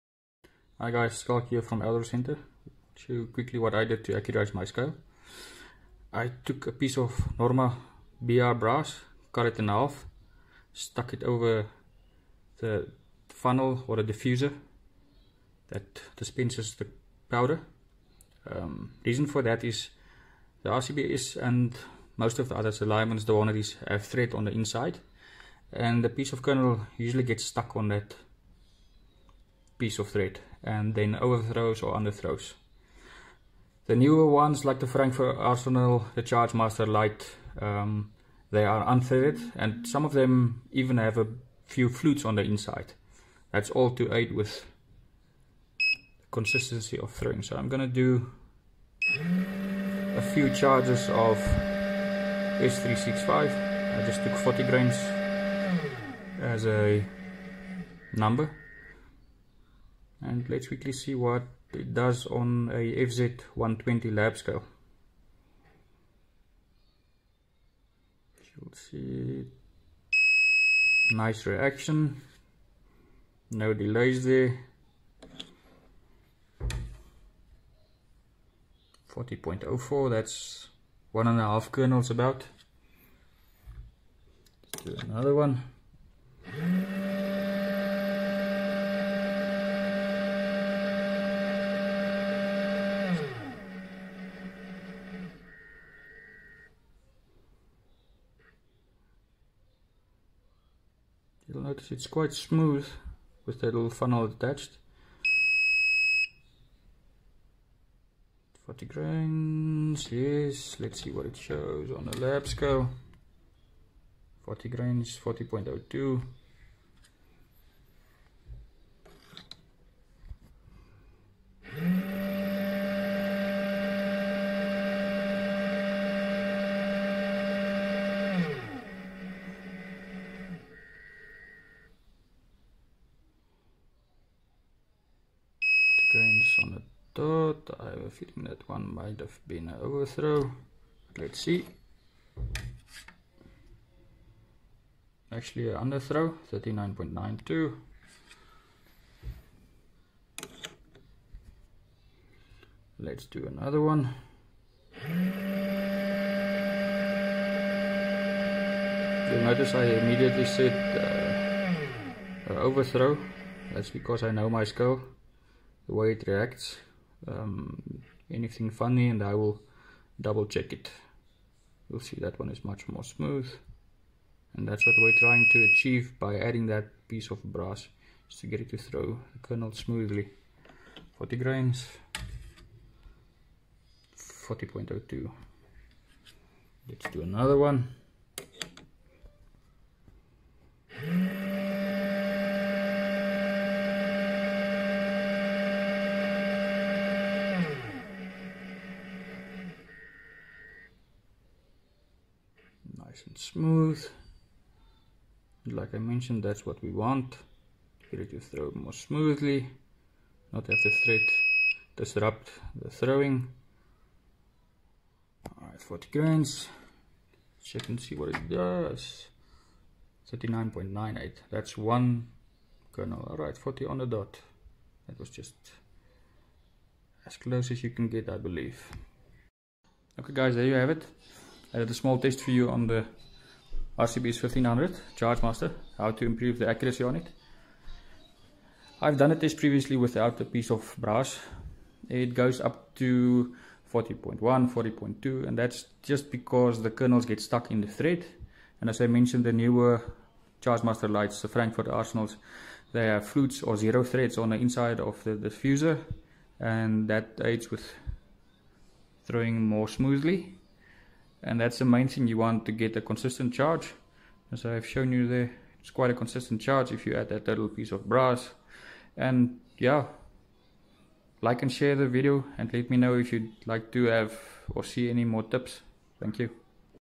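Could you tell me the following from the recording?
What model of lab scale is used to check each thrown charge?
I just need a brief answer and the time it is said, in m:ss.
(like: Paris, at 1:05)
FZ120, at 1:03.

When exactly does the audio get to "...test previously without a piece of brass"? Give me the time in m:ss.
3:59.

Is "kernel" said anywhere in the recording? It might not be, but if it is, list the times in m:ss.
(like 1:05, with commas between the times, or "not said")
0:26, 1:21, 2:59, 3:42, 4:06.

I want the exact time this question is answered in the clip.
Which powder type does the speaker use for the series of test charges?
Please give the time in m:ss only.
0:52.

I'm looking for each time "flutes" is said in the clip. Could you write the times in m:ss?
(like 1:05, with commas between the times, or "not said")
0:41, 4:13.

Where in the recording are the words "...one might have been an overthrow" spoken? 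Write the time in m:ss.
2:18.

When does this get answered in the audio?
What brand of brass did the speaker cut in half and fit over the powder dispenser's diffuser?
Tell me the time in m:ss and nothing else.
0:07.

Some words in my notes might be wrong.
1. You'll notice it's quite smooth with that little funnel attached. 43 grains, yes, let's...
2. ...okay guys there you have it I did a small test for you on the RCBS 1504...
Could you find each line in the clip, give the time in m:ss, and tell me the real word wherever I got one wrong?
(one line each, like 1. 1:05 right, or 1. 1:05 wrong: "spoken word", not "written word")
1. 1:41 wrong: "40", not "43"
2. 3:50 wrong: "1500", not "1504".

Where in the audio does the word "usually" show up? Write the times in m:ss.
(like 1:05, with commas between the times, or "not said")
0:26.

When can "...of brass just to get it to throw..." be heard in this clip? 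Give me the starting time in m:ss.
2:57.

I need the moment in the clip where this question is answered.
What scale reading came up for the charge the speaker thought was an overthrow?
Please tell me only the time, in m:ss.
2:26.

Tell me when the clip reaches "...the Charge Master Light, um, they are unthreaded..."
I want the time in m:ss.
0:36.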